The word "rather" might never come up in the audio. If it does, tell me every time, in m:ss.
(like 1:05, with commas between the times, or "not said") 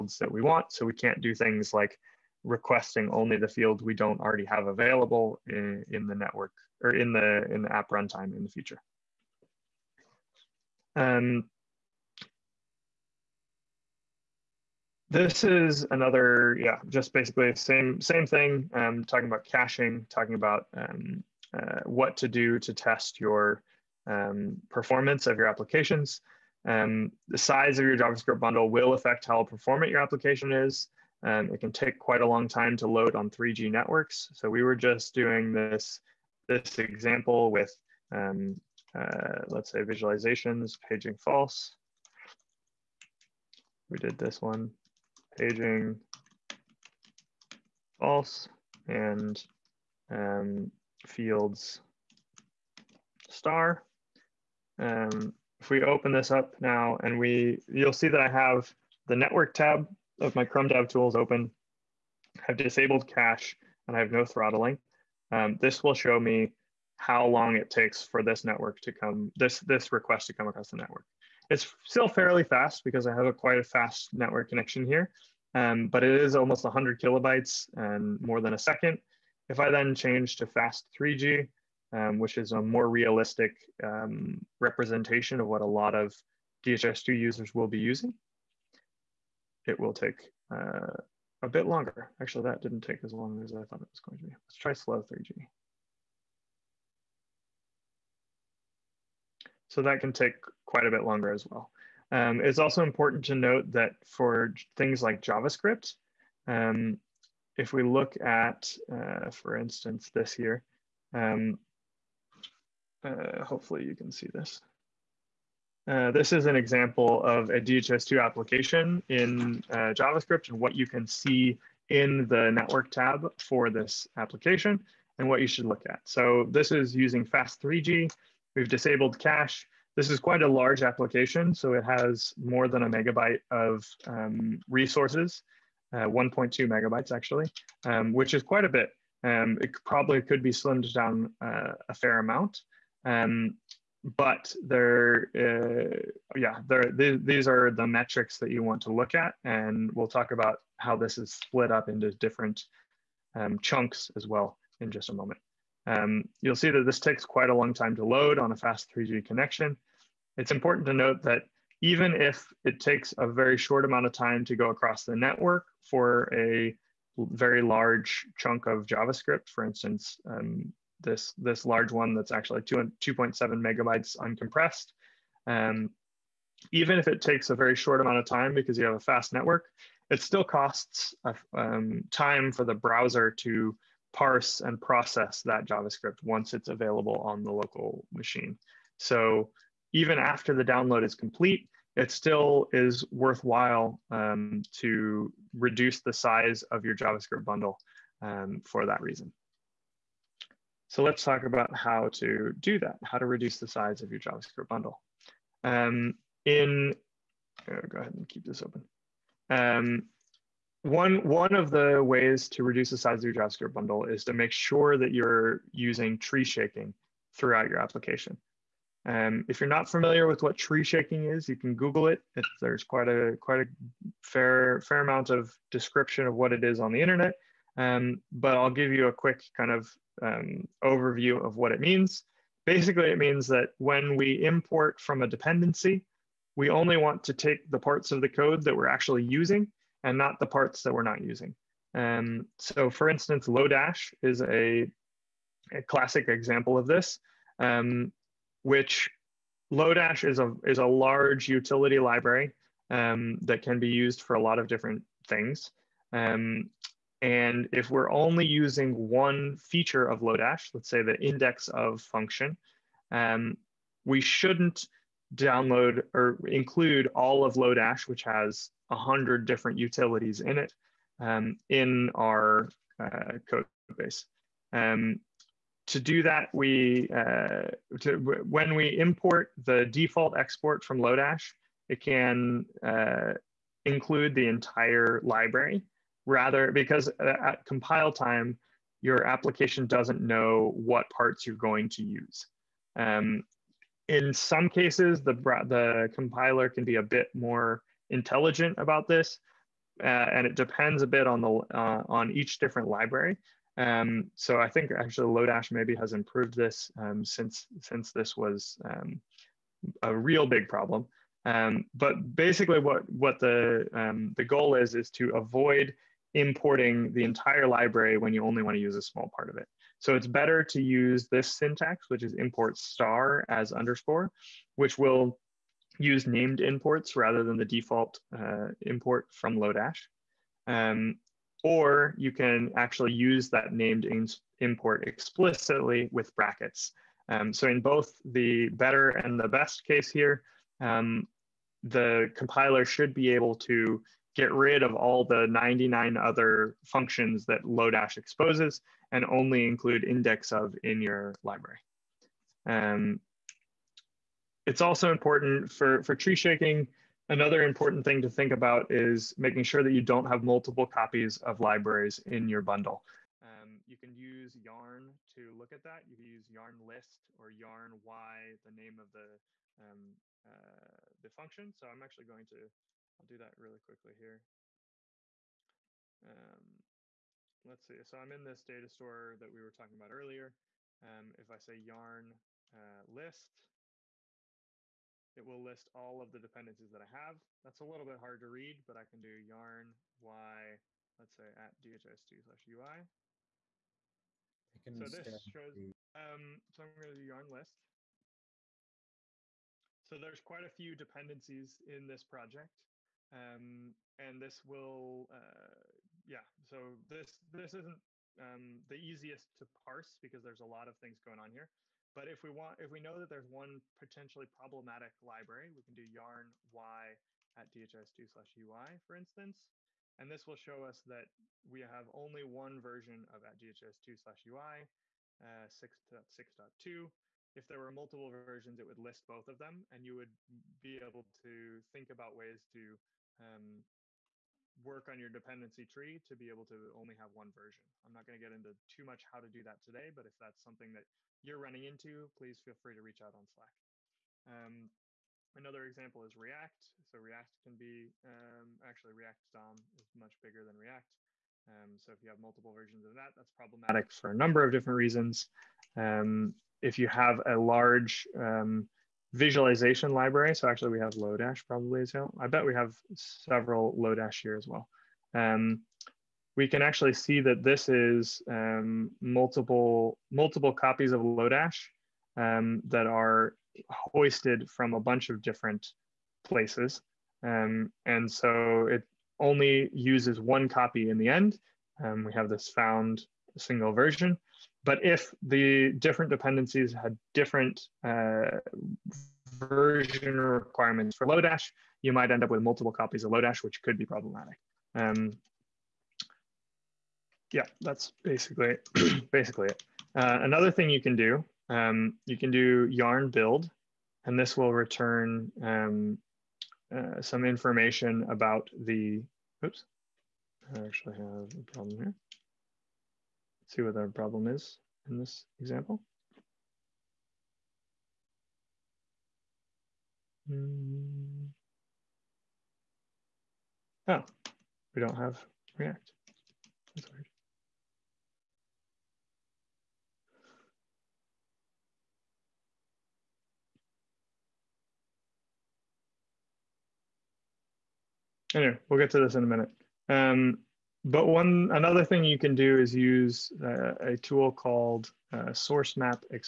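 4:46, 5:27.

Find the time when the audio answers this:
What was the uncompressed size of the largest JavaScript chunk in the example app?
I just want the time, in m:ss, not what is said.
2:52.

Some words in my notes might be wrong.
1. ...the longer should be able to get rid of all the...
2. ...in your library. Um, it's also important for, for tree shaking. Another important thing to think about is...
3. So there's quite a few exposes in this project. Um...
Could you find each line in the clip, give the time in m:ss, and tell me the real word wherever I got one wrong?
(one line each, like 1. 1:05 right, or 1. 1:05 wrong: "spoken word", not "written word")
1. 5:41 wrong: "compiler", not "longer"
2. 5:50 right
3. 6:40 wrong: "dependencies", not "exposes".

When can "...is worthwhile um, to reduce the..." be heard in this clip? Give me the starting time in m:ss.
3:12.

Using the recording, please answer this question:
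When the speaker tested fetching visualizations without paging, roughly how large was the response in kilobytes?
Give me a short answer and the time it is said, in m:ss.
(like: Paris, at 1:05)
100 kilobytes, at 1:16.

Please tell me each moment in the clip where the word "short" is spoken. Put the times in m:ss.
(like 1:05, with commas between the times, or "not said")
2:43, 2:57.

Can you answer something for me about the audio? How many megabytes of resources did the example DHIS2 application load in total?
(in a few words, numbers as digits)
1.2 megabytes.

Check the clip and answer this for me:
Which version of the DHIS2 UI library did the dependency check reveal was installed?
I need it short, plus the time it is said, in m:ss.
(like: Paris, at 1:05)
6.6.2, at 7:05.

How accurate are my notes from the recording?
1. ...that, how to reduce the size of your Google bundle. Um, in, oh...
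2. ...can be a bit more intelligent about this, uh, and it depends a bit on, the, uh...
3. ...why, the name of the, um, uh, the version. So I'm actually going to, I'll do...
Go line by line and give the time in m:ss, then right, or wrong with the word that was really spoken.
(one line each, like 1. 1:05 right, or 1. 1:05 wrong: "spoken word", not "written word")
1. 3:22 wrong: "JavaScript", not "Google"
2. 4:56 right
3. 6:08 wrong: "function", not "version".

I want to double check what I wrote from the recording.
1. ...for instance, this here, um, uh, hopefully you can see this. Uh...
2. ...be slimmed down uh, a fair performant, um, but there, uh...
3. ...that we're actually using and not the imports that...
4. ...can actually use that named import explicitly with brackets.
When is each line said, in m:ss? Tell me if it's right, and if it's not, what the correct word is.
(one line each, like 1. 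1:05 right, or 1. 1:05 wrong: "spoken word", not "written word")
1. 1:49 right
2. 2:20 wrong: "amount", not "performant"
3. 3:58 wrong: "parts", not "imports"
4. 5:32 right.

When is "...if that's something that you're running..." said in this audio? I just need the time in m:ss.
7:20.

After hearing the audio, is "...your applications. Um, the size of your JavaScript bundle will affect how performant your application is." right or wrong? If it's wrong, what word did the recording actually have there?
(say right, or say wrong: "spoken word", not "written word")
right.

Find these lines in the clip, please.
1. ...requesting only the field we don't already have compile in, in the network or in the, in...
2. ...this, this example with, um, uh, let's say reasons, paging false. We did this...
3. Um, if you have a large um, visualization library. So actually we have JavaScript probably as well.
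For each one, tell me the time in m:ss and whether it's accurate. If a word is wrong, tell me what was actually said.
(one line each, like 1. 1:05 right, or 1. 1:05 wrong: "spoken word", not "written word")
1. 0:02 wrong: "available", not "compile"
2. 0:35 wrong: "visualizations", not "reasons"
3. 7:35 wrong: "Lodash", not "JavaScript".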